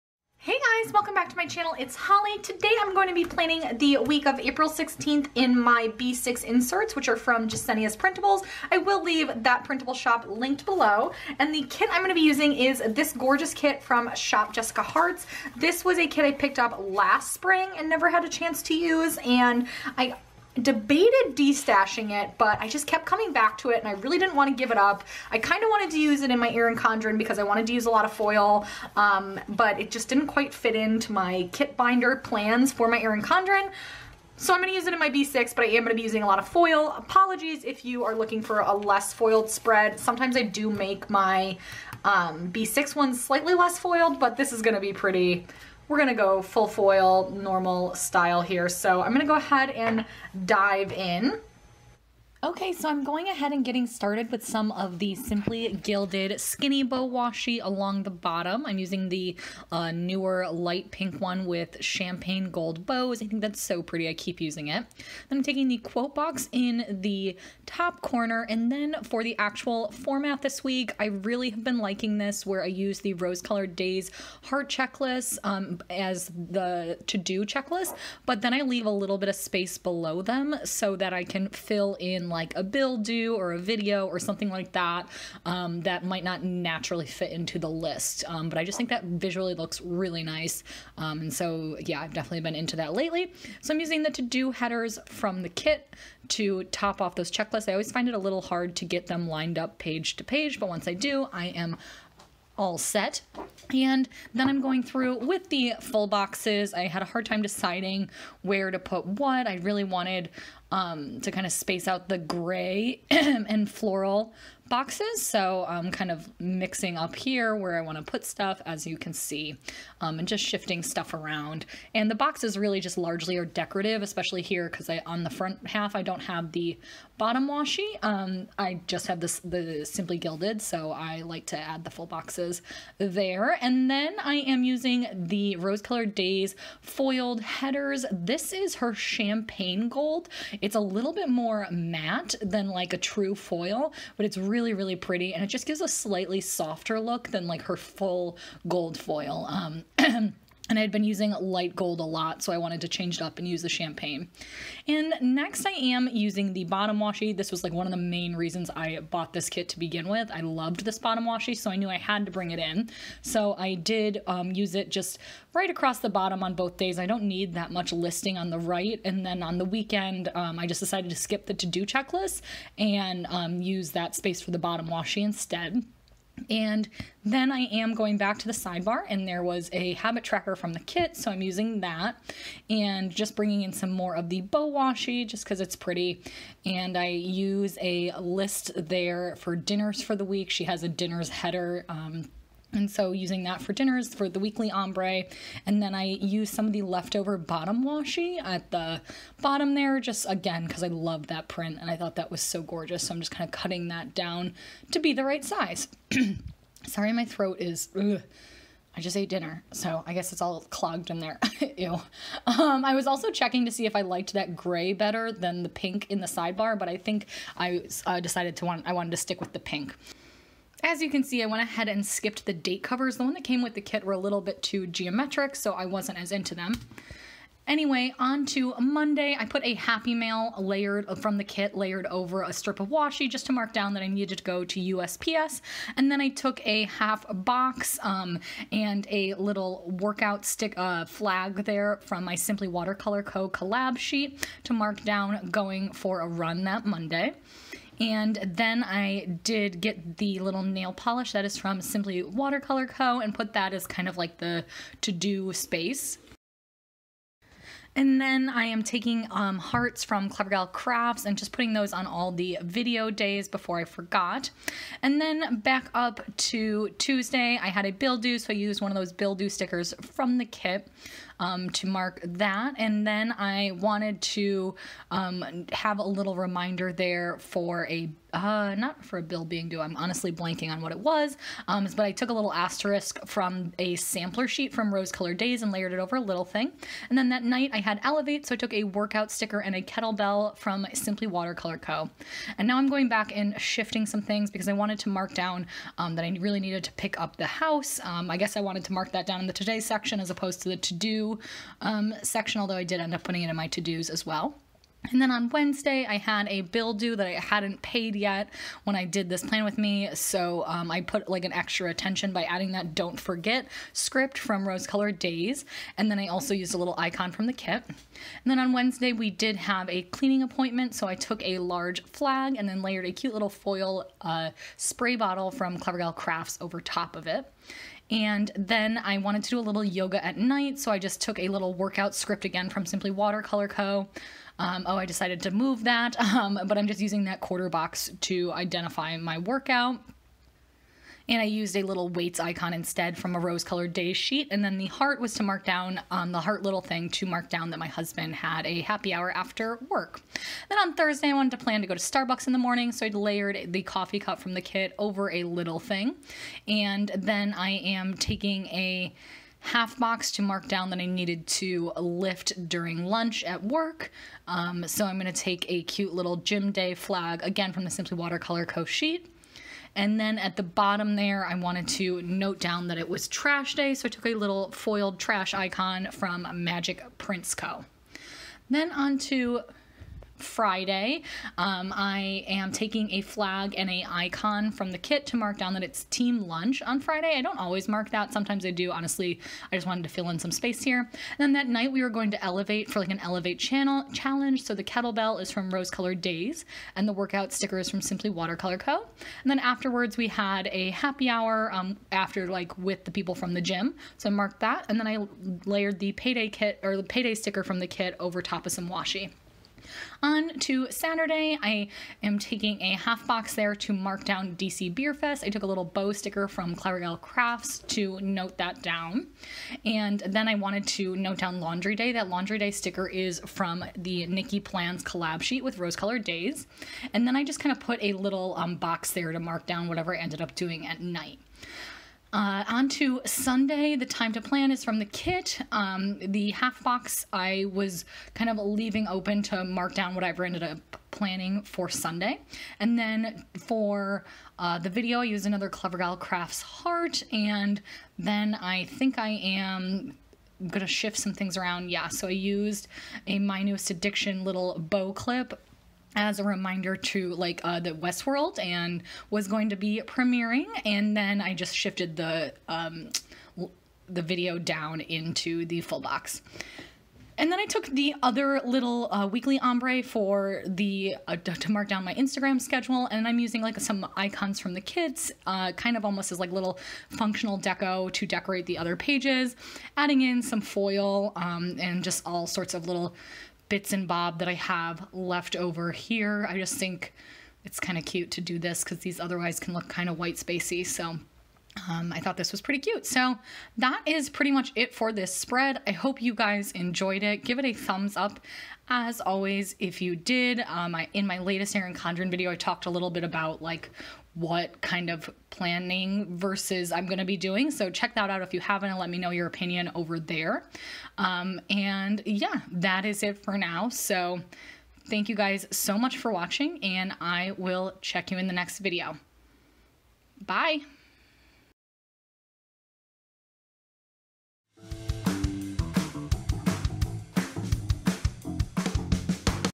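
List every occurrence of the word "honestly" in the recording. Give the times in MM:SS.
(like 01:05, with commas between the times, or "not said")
04:39, 06:28.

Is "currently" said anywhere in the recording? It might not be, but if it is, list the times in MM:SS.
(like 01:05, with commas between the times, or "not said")
not said.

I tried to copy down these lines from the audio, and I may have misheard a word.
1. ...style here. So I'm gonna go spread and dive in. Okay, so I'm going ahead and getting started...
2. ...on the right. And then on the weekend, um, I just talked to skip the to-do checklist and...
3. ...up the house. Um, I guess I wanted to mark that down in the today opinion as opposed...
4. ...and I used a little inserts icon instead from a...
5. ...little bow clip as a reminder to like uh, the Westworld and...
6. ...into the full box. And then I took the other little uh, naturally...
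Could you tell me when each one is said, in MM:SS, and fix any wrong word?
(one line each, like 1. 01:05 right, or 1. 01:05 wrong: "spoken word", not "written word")
1. 00:47 wrong: "ahead", not "spread"
2. 02:48 wrong: "decided", not "talked"
3. 04:57 wrong: "section", not "opinion"
4. 05:41 wrong: "weights", not "inserts"
5. 07:34 right
6. 07:45 wrong: "weekly", not "naturally".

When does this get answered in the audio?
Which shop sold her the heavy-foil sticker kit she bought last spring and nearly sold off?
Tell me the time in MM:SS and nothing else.
00:14.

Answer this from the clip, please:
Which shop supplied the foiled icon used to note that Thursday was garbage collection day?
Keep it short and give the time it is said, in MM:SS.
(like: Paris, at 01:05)
Magic Prints Co., at 06:16.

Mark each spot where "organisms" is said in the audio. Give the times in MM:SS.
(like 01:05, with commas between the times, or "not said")
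not said.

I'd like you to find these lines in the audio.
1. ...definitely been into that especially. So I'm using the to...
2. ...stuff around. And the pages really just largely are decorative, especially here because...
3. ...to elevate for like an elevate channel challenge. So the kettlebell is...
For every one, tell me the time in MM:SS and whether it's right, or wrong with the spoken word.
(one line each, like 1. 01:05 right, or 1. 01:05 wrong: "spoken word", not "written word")
1. 01:32 wrong: "lately", not "especially"
2. 02:00 wrong: "boxes", not "pages"
3. 06:32 right.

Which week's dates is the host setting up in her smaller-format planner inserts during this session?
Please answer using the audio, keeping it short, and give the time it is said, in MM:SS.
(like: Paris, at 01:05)
April 16th, at 00:04.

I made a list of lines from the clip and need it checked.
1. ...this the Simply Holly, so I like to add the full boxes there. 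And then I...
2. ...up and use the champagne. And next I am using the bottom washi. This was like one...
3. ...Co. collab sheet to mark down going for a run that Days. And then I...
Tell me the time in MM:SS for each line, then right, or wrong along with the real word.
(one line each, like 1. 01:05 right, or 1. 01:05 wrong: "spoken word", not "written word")
1. 02:09 wrong: "Gilded", not "Holly"
2. 02:33 right
3. 04:03 wrong: "Monday", not "Days".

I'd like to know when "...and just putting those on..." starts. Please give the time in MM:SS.
04:21.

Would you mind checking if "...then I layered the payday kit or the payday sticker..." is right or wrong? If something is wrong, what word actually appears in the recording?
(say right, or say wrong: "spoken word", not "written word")
right.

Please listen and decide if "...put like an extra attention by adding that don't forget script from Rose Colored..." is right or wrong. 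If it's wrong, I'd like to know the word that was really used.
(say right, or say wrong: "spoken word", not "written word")
right.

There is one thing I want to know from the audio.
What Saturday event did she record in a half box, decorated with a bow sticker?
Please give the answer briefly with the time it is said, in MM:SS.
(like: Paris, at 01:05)
DC Beer Fest, at 06:54.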